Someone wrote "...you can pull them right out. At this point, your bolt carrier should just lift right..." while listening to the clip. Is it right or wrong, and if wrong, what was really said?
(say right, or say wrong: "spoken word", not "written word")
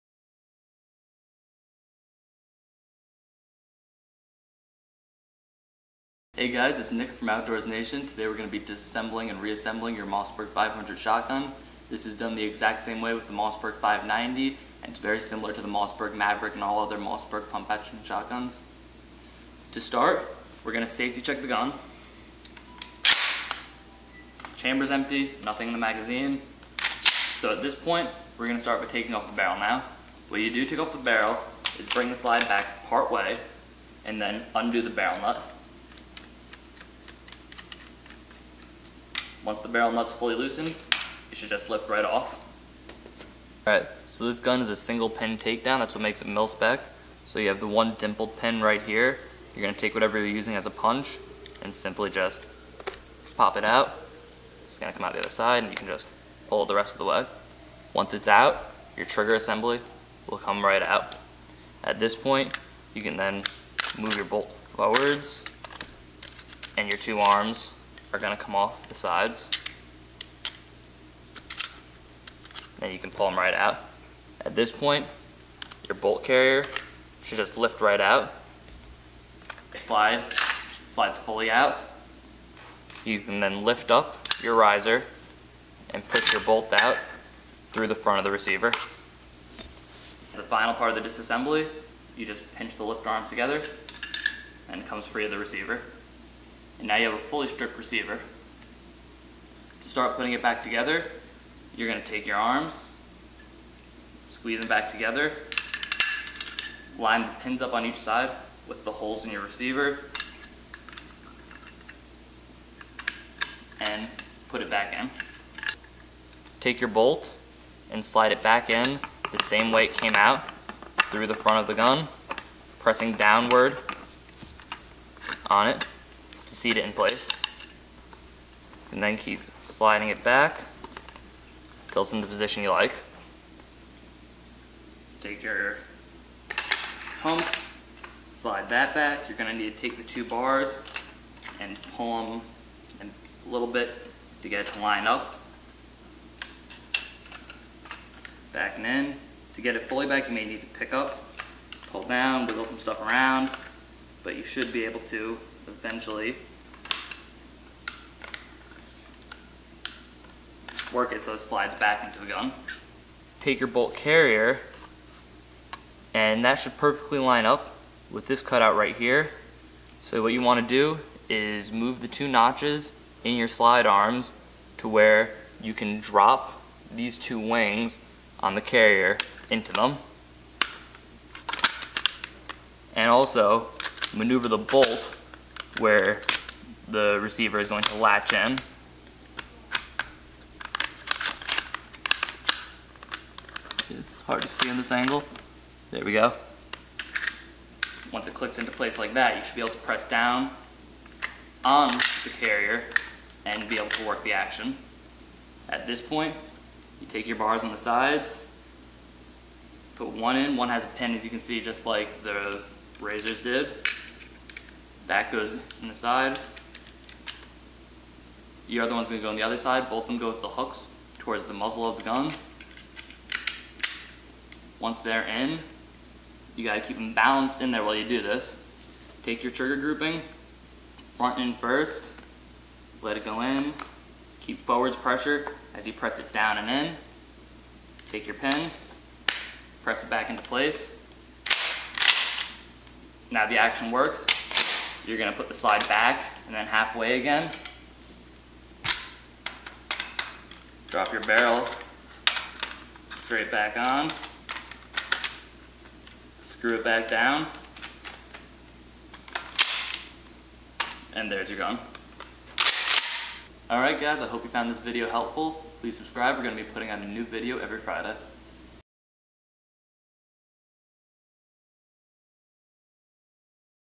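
right.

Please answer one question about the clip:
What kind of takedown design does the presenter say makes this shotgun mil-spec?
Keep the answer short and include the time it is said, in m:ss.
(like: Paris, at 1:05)
Single pin takedown, at 0:44.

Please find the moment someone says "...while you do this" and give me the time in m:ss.
3:47.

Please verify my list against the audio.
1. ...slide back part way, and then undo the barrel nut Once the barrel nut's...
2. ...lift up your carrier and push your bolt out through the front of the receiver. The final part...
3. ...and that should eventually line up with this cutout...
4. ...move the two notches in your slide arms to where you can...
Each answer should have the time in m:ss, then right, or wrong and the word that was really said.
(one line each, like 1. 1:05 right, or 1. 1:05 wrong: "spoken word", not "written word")
1. 0:32 right
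2. 1:23 wrong: "riser", not "carrier"
3. 2:46 wrong: "perfectly", not "eventually"
4. 2:51 right.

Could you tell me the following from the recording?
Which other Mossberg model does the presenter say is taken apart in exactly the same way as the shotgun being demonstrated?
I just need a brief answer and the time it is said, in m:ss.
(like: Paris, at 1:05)
Mossberg 590, at 0:13.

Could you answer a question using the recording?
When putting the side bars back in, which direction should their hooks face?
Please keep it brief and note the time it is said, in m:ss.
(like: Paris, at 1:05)
Towards the muzzle, at 3:41.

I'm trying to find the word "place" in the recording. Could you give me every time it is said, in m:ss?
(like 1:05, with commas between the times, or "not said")
2:06, 3:18, 4:00.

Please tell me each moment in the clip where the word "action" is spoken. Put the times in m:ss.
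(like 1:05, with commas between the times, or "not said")
0:17, 3:24, 4:03.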